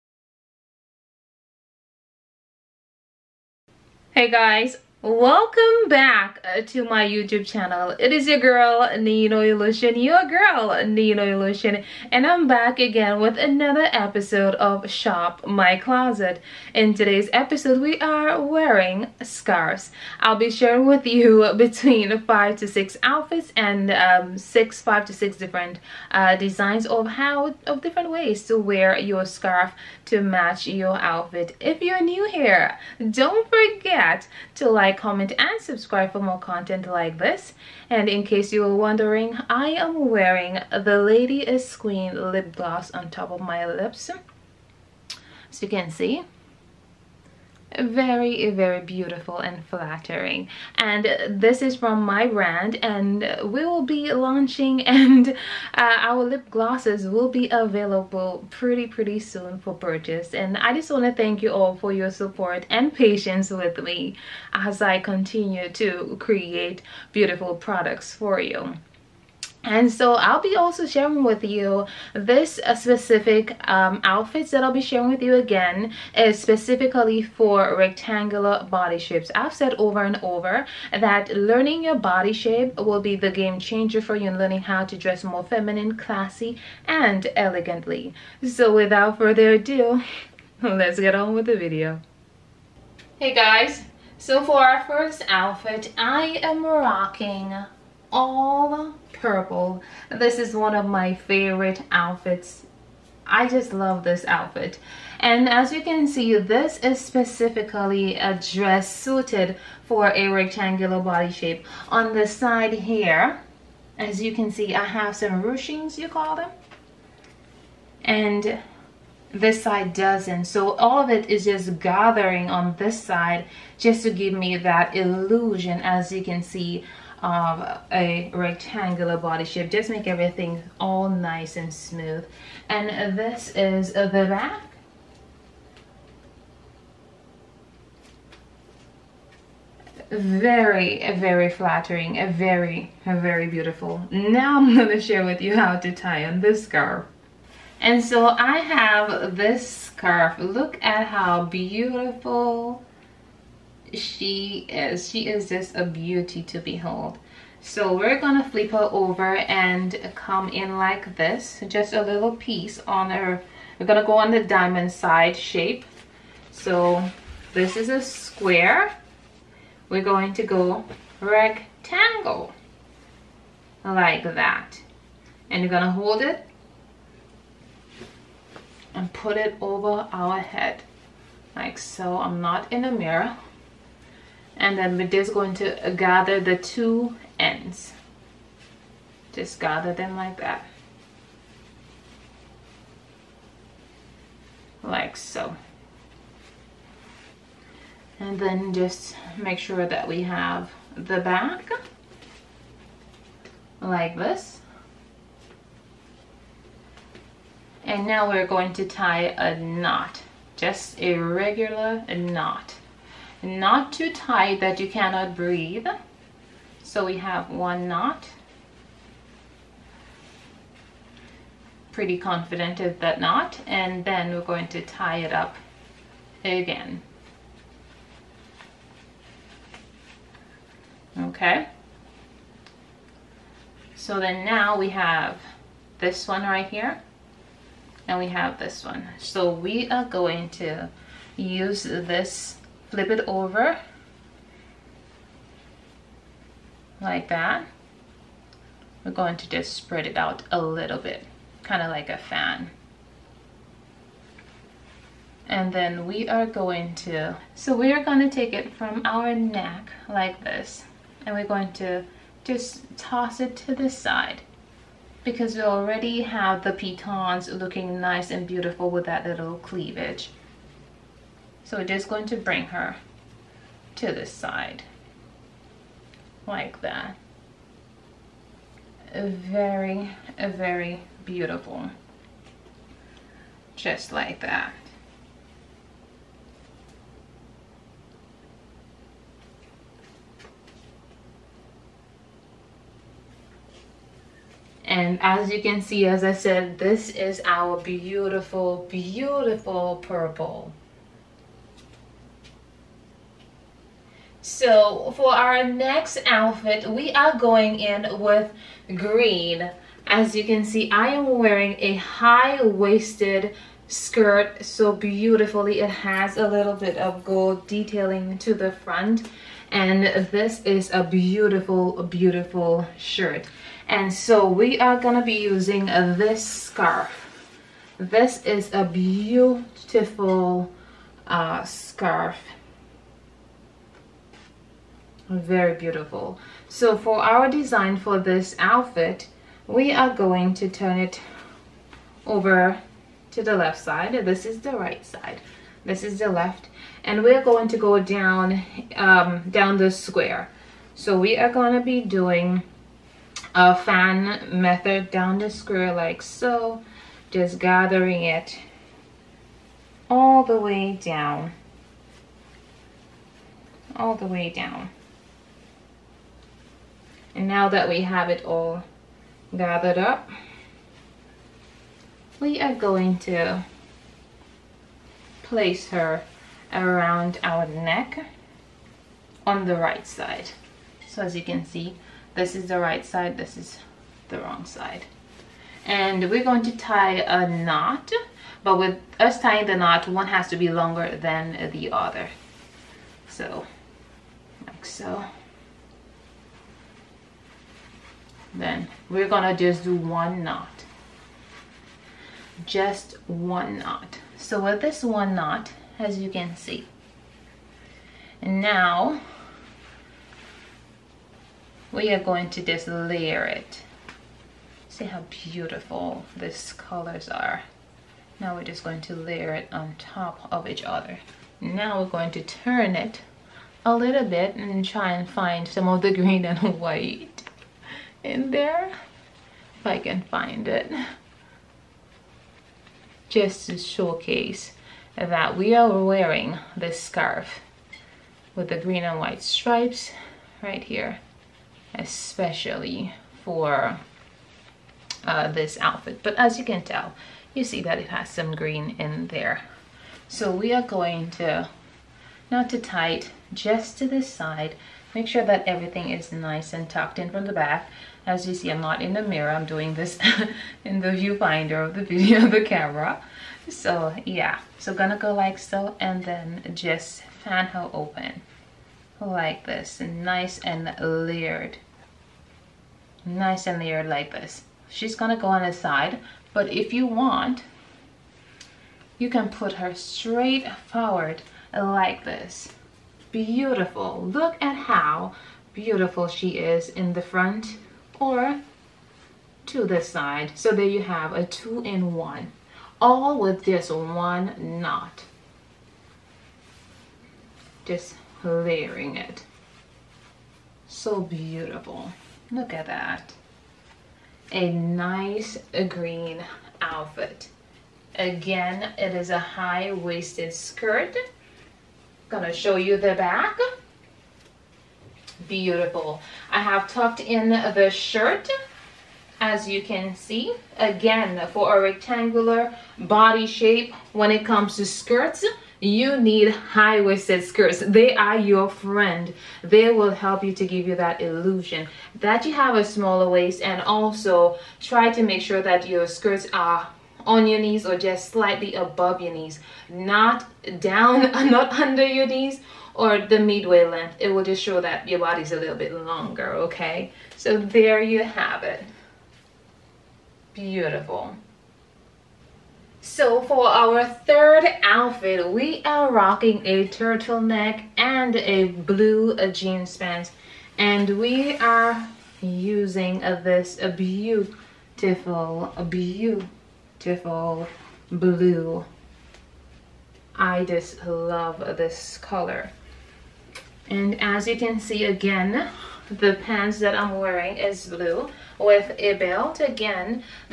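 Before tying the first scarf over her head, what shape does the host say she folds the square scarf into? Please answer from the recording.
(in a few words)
rectangle.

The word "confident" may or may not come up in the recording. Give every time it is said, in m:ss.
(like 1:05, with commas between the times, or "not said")
3:42.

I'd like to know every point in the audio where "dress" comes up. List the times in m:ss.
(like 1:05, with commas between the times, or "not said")
1:24, 1:48.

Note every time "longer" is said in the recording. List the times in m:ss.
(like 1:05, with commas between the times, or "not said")
6:30, 9:05.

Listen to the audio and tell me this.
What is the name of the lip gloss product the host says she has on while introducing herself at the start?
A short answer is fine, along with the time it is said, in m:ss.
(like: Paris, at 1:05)
Lady is Queen, at 0:41.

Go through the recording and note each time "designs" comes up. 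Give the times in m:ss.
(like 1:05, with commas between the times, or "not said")
0:26, 5:37.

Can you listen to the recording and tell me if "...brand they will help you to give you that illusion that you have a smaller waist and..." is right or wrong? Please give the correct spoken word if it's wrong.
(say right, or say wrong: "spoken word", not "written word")
wrong: "friend", not "brand".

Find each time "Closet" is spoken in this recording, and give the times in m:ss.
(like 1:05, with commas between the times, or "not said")
0:15.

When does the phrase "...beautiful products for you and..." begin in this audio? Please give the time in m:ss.
1:07.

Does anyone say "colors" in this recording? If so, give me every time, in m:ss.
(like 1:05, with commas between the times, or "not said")
6:56, 9:32.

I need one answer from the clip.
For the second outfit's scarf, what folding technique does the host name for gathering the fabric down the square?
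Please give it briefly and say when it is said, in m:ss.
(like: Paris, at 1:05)
fan method, at 5:53.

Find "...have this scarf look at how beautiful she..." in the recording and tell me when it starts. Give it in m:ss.
2:28.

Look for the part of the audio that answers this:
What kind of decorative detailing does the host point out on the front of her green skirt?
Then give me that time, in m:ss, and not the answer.
5:17.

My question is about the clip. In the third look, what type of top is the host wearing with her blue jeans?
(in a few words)
turtleneck.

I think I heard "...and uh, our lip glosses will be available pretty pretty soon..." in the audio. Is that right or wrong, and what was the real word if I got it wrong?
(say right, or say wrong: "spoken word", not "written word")
right.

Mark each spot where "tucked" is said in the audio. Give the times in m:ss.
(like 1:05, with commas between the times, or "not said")
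7:36, 8:36.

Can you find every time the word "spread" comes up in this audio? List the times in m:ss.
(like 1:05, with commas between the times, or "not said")
4:09.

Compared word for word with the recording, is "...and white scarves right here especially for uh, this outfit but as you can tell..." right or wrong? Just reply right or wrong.
wrong.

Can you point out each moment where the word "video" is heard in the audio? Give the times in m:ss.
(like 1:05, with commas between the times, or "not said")
1:31, 7:42.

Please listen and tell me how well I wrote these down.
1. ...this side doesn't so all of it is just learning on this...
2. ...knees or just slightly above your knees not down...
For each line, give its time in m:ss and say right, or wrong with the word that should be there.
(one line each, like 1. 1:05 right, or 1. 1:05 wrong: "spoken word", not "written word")
1. 1:59 wrong: "gathering", not "learning"
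2. 8:57 right.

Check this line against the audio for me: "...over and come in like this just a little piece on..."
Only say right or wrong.
right.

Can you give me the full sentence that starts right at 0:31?
If you're new here, don't forget to like like, comment, and subscribe for more content like this.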